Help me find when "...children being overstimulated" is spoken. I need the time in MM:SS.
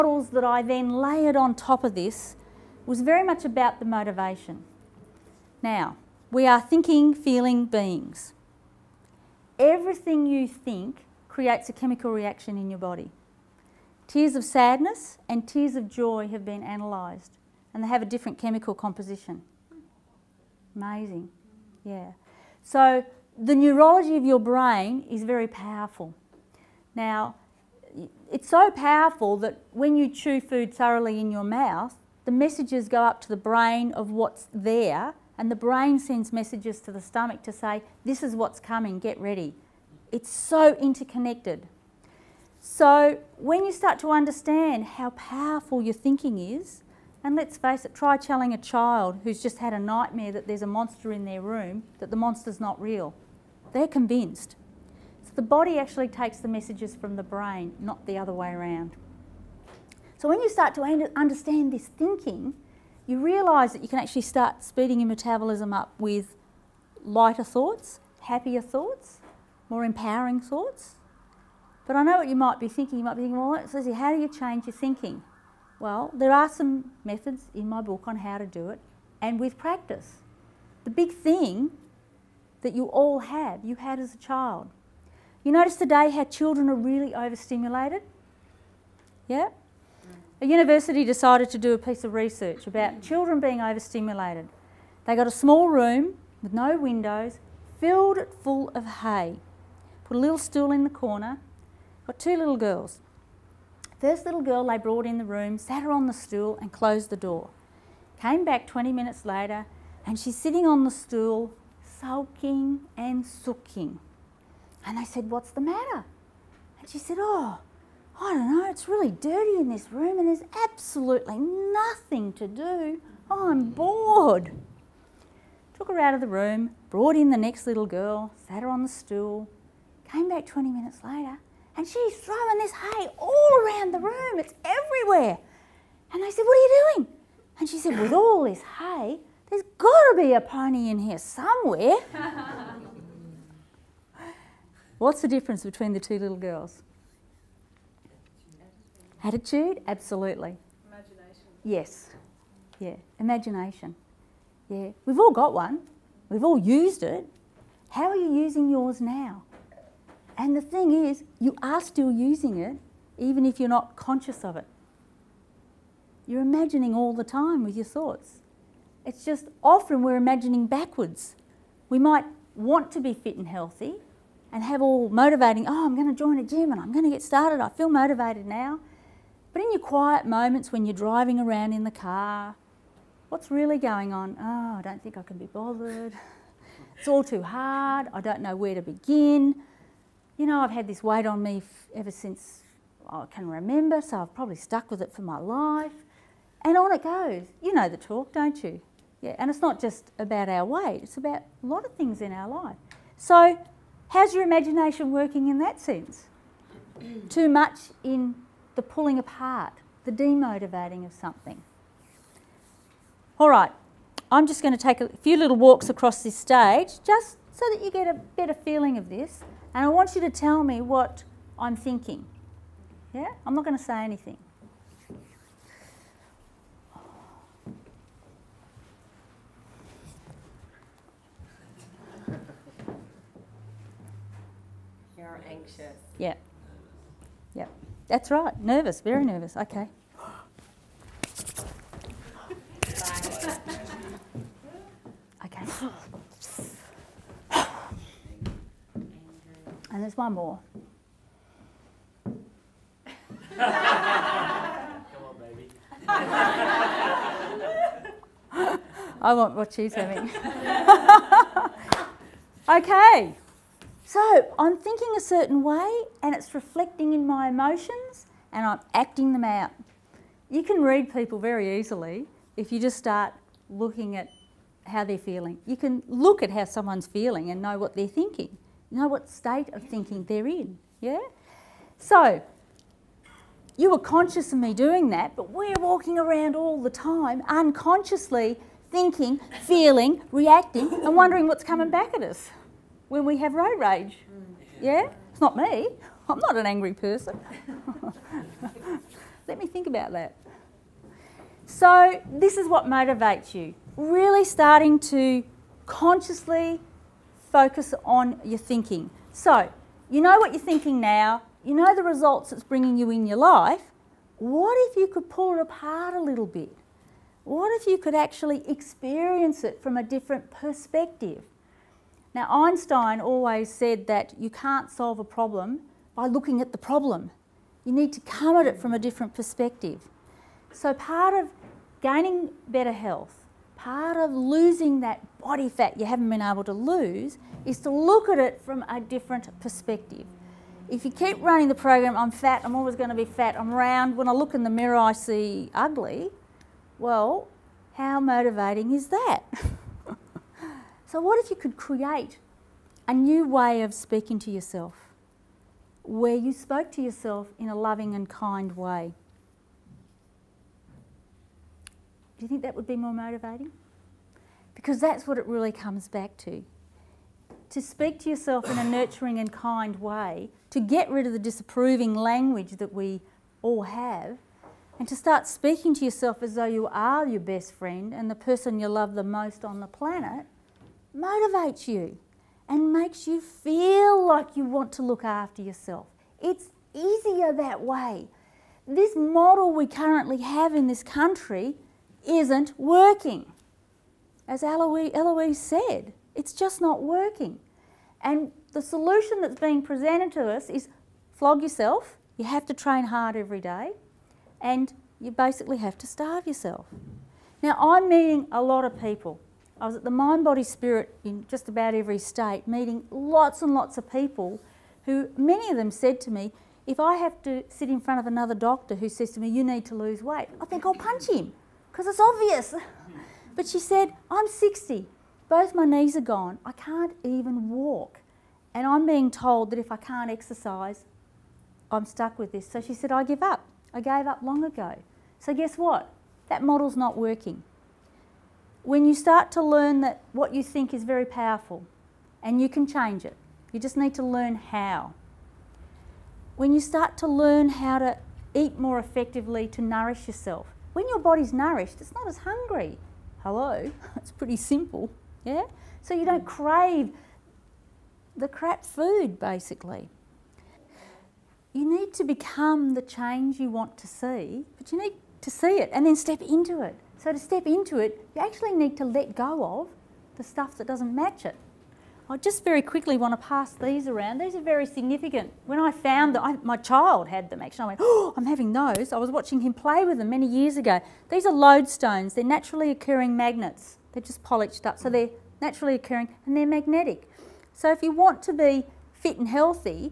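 01:33.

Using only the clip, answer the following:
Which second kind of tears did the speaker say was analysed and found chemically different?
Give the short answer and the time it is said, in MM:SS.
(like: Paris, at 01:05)
tears of joy, at 00:15.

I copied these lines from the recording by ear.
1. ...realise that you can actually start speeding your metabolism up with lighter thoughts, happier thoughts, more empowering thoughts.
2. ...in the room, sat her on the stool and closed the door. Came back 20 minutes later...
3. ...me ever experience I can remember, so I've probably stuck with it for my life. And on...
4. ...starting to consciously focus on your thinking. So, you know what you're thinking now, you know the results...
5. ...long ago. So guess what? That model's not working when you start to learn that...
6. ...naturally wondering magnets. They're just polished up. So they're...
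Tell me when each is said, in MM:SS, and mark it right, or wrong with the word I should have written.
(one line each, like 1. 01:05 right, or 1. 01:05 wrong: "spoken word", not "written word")
1. 01:03 right
2. 01:45 right
3. 03:11 wrong: "since", not "experience"
4. 05:04 right
5. 07:14 right
6. 08:02 wrong: "occurring", not "wondering".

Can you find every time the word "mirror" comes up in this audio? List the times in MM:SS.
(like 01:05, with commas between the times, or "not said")
05:44.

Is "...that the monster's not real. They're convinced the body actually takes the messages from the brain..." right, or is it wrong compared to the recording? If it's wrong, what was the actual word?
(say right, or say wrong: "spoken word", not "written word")
right.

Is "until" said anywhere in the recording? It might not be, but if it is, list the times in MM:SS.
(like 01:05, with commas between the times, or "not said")
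not said.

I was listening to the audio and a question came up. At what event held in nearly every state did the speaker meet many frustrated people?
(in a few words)
Mind, Body, Spirit.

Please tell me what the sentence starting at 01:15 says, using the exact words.
Well, there are some methods in my book on how to do it and with practice.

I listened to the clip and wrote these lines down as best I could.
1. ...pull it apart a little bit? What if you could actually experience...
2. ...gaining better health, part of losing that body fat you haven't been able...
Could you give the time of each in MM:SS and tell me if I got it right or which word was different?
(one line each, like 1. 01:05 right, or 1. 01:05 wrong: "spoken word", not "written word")
1. 05:15 right
2. 05:32 right.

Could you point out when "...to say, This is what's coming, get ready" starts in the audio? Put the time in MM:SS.
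00:37.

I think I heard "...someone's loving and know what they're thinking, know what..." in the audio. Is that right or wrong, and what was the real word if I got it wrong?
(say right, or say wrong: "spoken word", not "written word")
wrong: "feeling", not "loving".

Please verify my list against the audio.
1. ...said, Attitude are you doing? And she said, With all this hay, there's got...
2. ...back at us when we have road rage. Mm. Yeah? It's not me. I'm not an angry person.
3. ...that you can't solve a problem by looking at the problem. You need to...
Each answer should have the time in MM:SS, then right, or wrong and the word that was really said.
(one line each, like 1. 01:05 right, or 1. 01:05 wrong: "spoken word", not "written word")
1. 02:16 wrong: "What", not "Attitude"
2. 04:51 right
3. 05:24 right.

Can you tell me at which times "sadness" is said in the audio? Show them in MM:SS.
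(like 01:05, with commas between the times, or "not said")
00:14.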